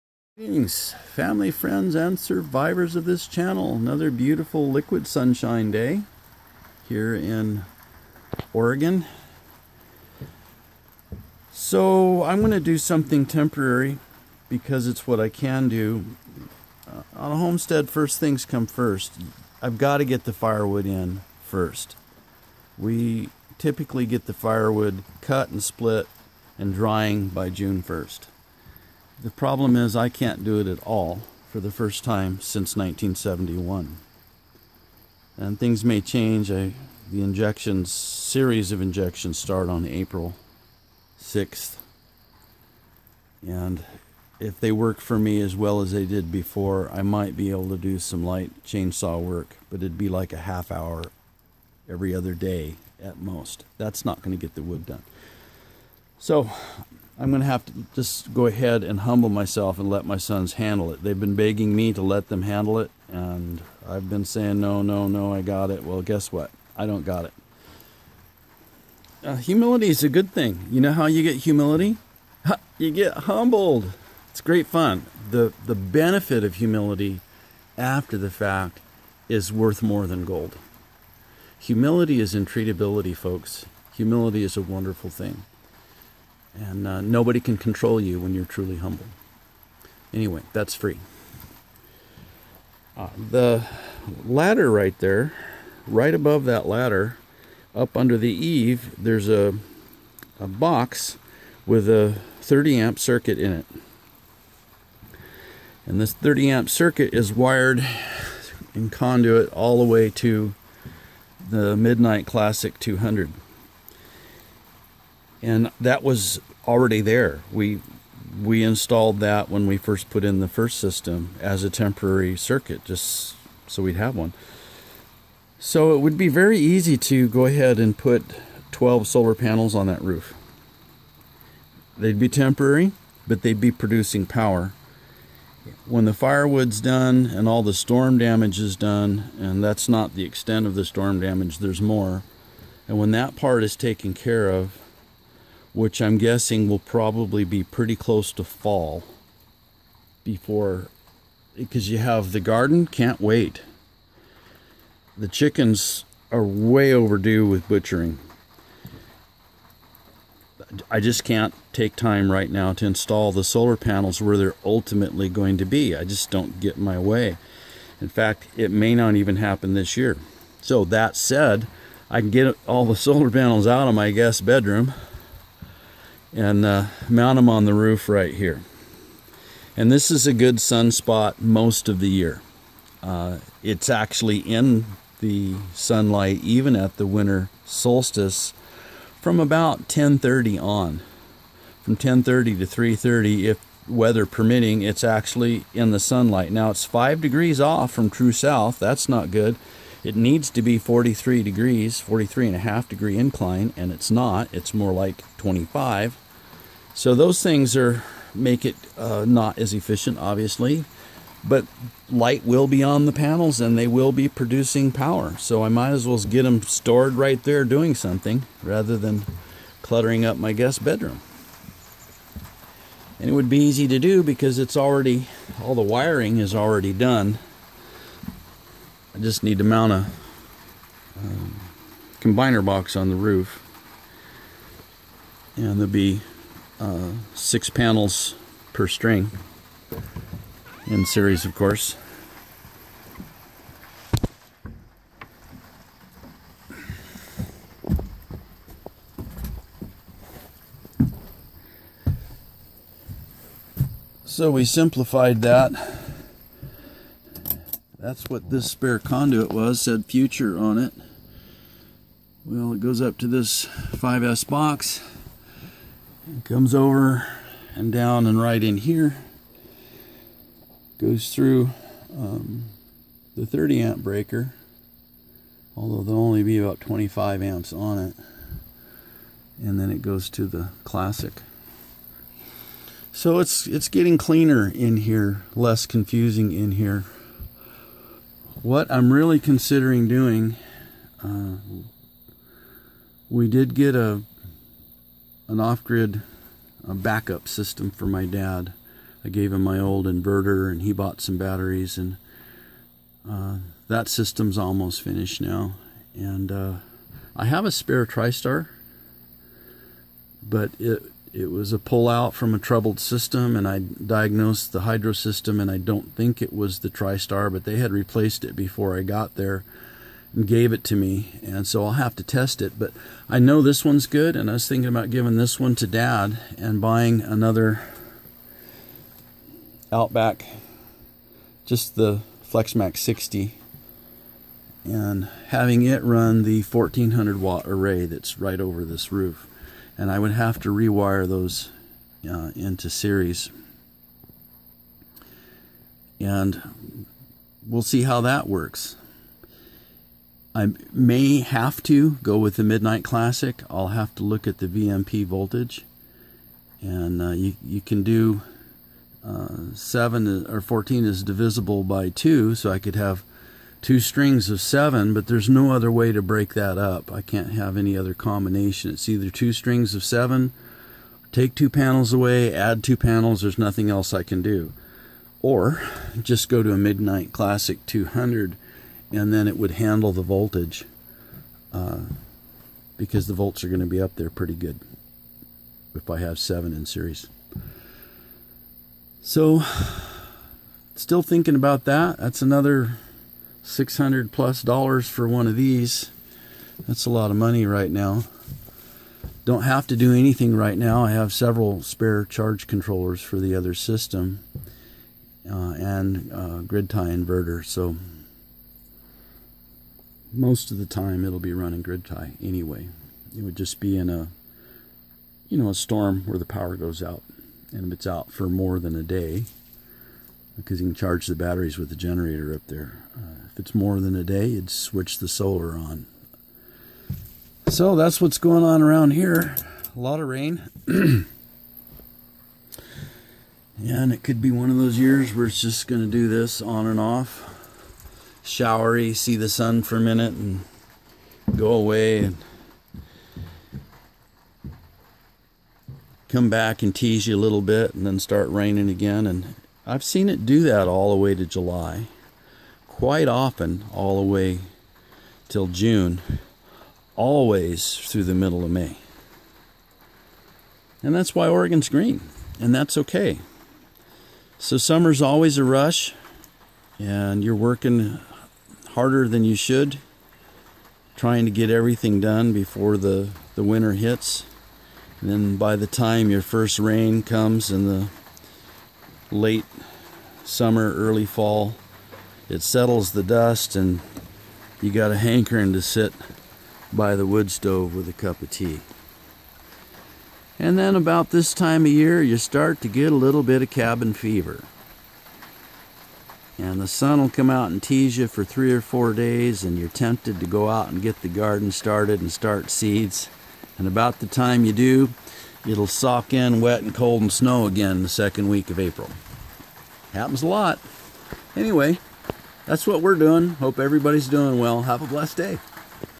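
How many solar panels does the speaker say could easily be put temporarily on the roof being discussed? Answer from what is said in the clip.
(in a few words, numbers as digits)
12.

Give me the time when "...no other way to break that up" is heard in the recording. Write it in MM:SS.
06:05.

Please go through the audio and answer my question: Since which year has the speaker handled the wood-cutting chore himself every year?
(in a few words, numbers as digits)
1971.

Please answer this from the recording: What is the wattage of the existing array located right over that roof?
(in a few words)
1400 watt.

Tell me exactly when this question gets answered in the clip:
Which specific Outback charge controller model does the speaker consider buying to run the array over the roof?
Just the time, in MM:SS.
05:32.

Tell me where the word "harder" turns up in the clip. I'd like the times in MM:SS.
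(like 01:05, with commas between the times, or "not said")
07:48.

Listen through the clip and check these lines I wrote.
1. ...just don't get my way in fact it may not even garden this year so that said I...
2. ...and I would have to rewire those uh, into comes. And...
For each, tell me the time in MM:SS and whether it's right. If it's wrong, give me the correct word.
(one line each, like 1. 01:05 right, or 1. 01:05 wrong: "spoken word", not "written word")
1. 02:46 wrong: "happen", not "garden"
2. 05:39 wrong: "series", not "comes".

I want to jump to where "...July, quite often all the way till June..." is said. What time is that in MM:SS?
07:31.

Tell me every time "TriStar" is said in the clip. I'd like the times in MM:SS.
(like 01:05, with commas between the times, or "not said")
05:08, 05:16.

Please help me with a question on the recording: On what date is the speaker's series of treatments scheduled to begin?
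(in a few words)
April 6th.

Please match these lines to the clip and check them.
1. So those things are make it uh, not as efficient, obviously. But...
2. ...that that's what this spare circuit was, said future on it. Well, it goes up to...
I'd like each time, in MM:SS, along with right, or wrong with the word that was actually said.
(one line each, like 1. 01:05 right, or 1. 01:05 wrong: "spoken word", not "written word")
1. 03:26 right
2. 04:15 wrong: "conduit", not "circuit".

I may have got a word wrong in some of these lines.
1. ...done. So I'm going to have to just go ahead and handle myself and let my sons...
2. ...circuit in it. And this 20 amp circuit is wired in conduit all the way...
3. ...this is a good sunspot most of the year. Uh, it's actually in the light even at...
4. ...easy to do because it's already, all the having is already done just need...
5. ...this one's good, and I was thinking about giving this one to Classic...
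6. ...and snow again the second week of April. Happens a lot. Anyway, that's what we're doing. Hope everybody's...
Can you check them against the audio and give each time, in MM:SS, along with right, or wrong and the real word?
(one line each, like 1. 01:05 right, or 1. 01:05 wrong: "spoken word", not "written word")
1. 00:54 wrong: "humble", not "handle"
2. 01:42 wrong: "30", not "20"
3. 02:59 wrong: "sunlight", not "light"
4. 03:43 wrong: "wiring", not "having"
5. 05:23 wrong: "Dad", not "Classic"
6. 08:27 right.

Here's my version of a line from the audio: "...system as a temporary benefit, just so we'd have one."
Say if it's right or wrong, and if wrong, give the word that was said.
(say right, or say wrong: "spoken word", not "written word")
wrong: "circuit", not "benefit".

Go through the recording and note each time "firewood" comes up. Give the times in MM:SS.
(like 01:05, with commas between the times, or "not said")
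00:20, 00:24, 02:16.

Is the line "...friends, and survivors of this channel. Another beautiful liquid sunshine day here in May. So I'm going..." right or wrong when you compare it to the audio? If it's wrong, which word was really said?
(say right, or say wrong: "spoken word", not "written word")
wrong: "Oregon", not "May".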